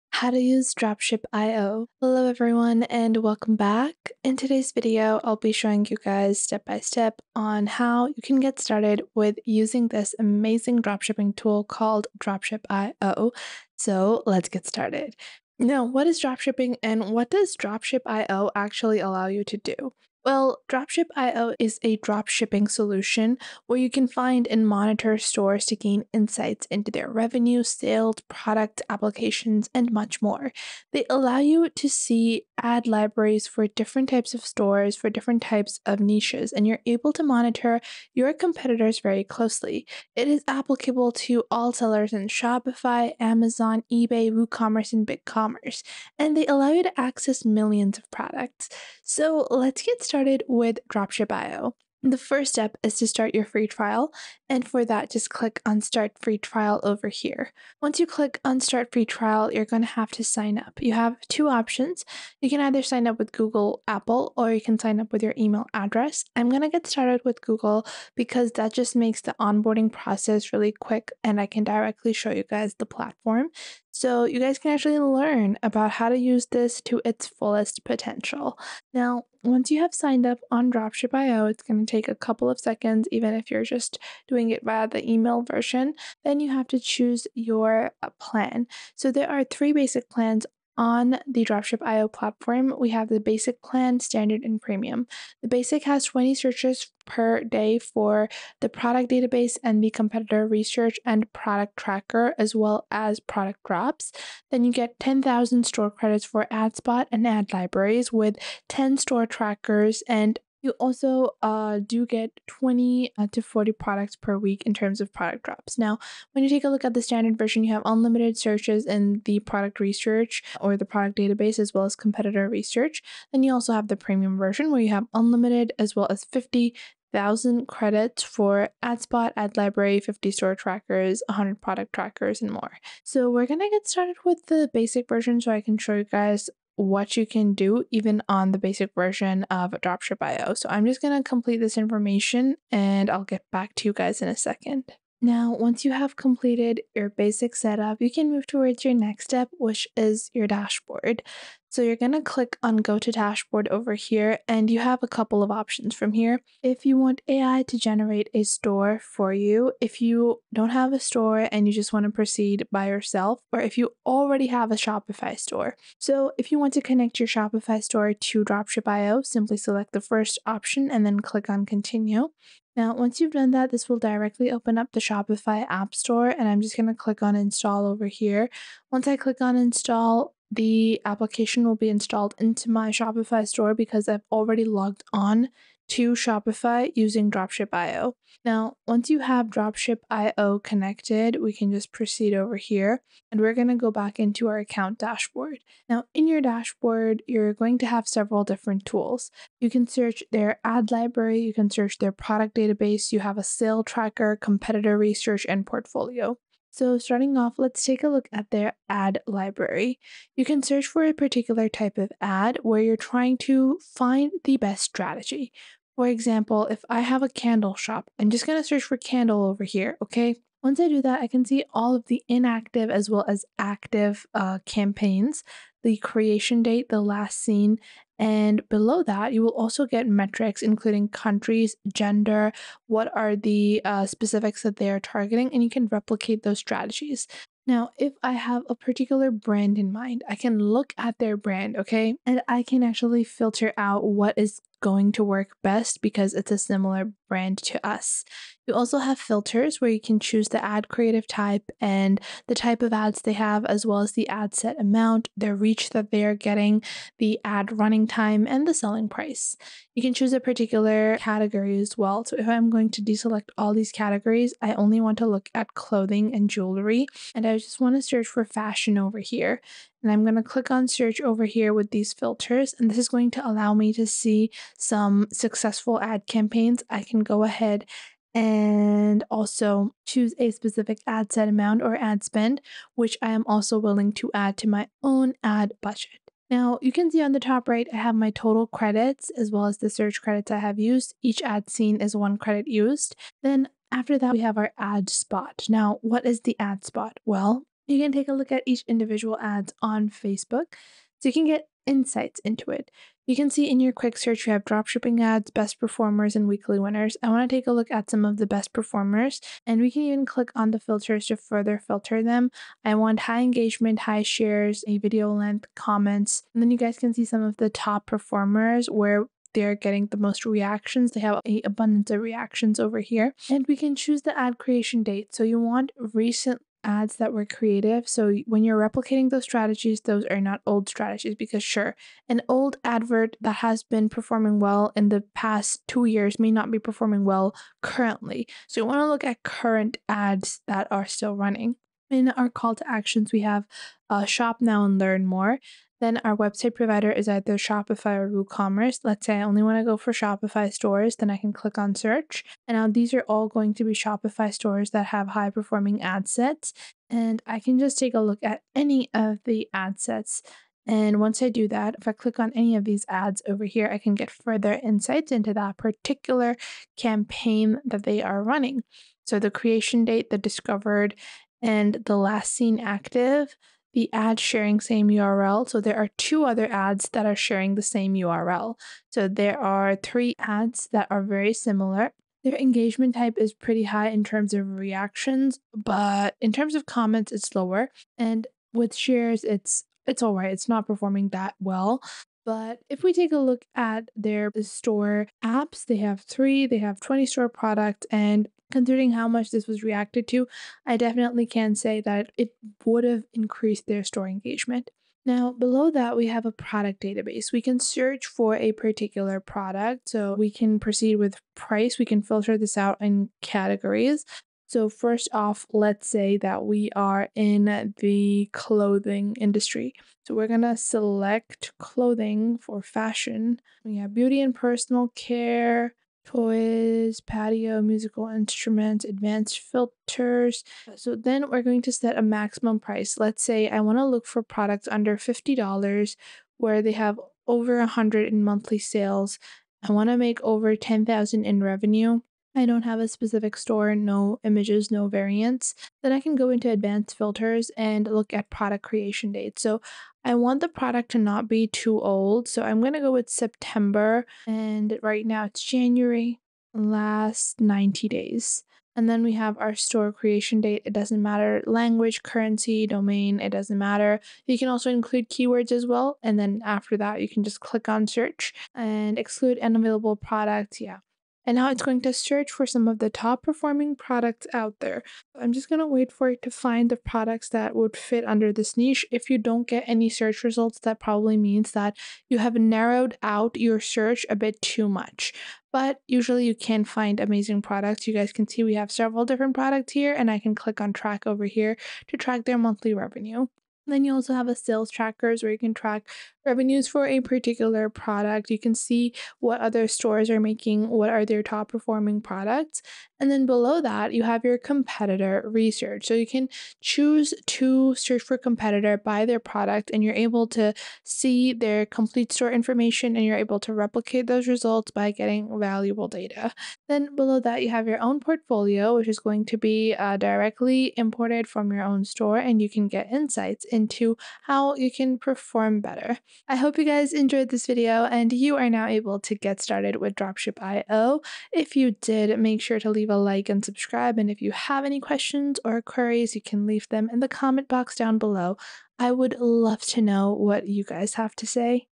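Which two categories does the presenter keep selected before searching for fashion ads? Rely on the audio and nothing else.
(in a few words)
clothing and jewelry.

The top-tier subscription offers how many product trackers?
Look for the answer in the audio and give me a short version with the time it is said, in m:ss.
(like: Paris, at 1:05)
100, at 2:11.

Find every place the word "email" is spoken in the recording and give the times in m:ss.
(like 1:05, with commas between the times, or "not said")
1:05, 1:25.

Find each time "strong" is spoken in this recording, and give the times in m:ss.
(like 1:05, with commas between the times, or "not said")
not said.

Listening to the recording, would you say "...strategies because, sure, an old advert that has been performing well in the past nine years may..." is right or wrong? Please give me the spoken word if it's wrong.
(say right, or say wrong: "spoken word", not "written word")
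wrong: "two", not "nine".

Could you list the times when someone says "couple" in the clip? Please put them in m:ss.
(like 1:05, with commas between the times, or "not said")
1:22, 2:35.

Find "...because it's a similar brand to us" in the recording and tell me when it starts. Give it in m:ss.
4:06.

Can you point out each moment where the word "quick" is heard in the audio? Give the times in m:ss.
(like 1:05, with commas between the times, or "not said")
1:10, 5:03.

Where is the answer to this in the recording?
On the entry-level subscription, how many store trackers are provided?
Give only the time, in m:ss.
1:48.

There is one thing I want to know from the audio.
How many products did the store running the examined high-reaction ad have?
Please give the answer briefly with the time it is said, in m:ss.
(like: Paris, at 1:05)
20, at 6:36.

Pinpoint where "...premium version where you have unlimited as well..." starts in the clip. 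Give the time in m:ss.
2:03.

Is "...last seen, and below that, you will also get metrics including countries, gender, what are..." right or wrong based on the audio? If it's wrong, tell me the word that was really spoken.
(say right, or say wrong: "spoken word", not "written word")
right.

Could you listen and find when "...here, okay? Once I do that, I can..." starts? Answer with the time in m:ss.
3:39.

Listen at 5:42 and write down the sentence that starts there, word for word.
In our call to actions, we have uh, shop now and learn more.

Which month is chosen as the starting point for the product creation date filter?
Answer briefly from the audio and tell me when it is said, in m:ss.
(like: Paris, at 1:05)
September, at 7:33.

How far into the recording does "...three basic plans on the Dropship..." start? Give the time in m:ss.
1:29.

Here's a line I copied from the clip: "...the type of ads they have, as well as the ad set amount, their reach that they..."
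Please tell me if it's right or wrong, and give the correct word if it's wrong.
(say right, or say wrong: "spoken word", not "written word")
right.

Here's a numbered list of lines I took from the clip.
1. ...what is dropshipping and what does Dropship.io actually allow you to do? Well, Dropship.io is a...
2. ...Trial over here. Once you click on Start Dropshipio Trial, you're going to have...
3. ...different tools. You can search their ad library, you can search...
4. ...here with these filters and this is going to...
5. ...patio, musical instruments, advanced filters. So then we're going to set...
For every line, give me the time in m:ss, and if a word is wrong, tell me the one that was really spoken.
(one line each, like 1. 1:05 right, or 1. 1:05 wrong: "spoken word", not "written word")
1. 0:15 right
2. 0:56 wrong: "Free", not "Dropshipio"
3. 3:18 right
4. 4:31 right
5. 7:07 right.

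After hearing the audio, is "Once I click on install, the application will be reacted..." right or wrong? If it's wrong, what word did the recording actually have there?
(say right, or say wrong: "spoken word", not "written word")
wrong: "installed", not "reacted".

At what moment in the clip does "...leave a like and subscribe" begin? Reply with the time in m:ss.
8:52.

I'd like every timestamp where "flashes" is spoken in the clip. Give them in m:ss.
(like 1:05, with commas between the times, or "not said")
not said.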